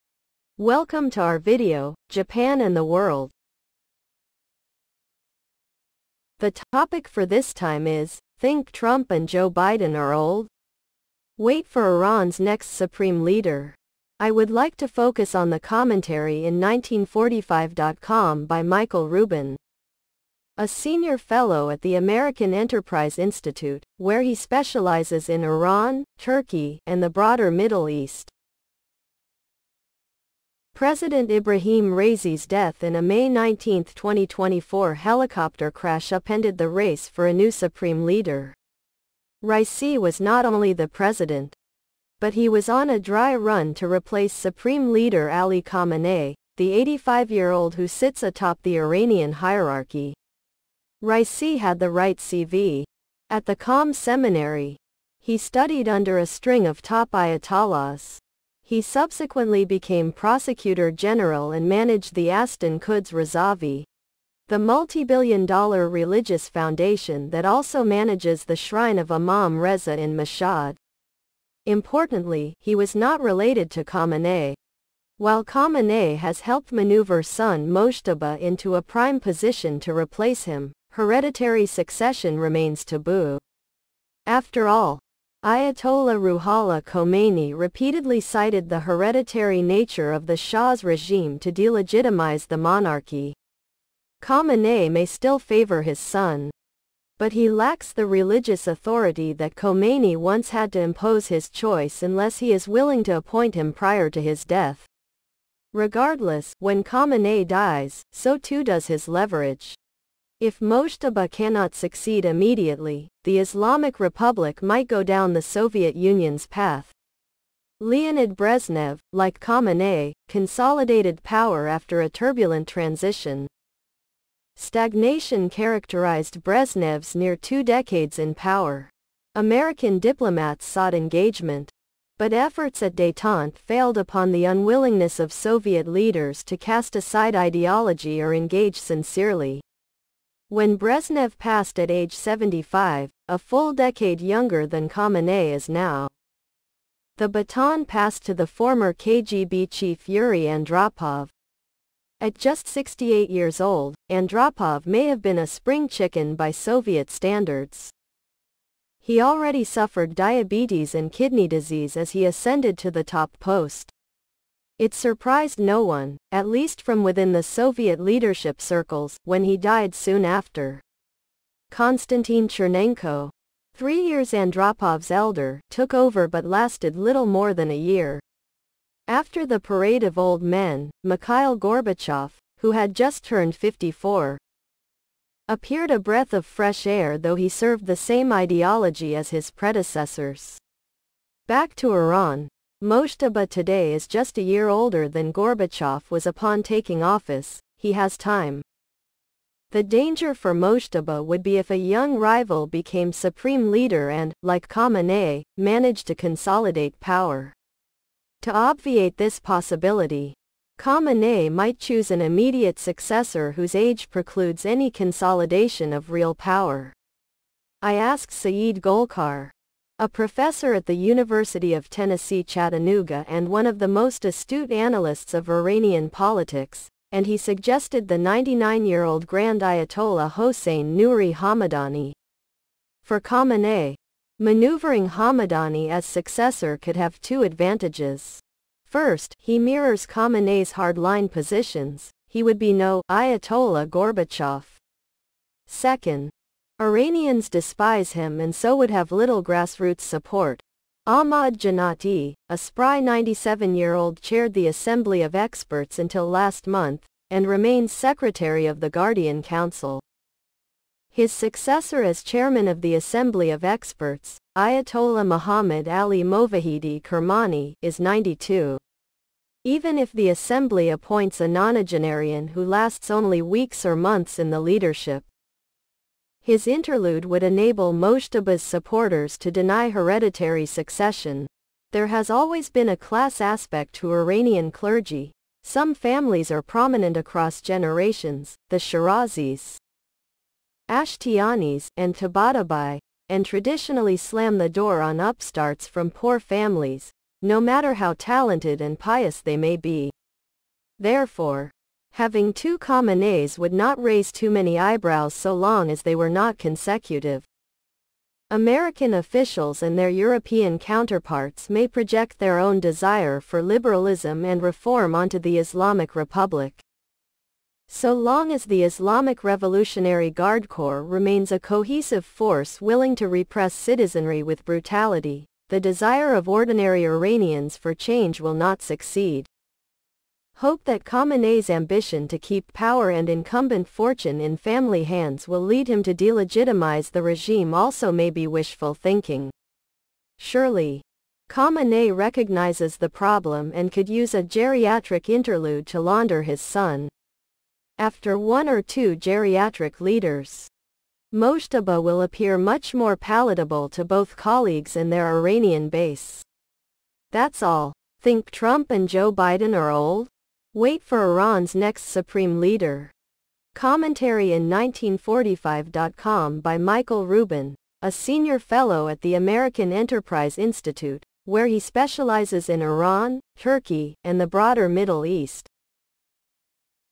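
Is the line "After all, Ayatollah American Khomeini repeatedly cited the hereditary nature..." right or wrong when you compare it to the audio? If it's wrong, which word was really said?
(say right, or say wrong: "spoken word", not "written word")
wrong: "Ruhollah", not "American".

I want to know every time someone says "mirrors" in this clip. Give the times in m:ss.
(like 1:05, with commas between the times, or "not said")
3:59.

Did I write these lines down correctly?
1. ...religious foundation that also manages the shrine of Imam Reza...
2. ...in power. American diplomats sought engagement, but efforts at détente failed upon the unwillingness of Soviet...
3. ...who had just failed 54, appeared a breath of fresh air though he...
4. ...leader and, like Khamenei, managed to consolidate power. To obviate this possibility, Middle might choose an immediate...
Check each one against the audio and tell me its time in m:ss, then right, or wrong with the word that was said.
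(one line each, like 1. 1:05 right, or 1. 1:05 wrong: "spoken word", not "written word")
1. 1:05 right
2. 2:08 right
3. 3:02 wrong: "turned", not "failed"
4. 3:23 wrong: "Khamenei", not "Middle".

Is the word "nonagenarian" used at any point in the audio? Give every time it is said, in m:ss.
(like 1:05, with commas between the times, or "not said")
4:31.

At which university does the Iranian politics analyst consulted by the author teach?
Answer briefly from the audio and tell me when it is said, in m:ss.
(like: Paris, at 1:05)
University of Tennessee Chattanooga, at 3:40.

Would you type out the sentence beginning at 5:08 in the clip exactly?
American officials and their European counterparts may project their own desire for liberalism and reform onto the Islamic Republic.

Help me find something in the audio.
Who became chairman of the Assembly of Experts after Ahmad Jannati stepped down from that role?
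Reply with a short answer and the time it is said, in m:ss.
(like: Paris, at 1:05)
Muhammad Ali Movahedi Kermani, at 4:25.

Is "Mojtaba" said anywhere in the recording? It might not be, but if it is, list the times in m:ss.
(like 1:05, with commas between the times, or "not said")
1:17, 1:50, 3:12, 3:20, 4:37, 5:51.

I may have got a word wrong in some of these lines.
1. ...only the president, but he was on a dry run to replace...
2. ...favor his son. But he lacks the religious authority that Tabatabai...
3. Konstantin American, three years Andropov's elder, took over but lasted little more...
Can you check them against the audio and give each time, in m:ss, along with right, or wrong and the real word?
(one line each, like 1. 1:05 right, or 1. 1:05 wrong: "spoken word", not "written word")
1. 0:40 right
2. 1:35 wrong: "Khomeini", not "Tabatabai"
3. 2:51 wrong: "Chernenko", not "American".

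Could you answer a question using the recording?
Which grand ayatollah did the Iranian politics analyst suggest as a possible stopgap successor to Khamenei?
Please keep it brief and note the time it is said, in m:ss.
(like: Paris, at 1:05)
Hossein Nouri Hamadani, at 3:50.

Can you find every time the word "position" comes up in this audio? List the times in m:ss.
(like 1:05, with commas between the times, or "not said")
1:19, 4:01.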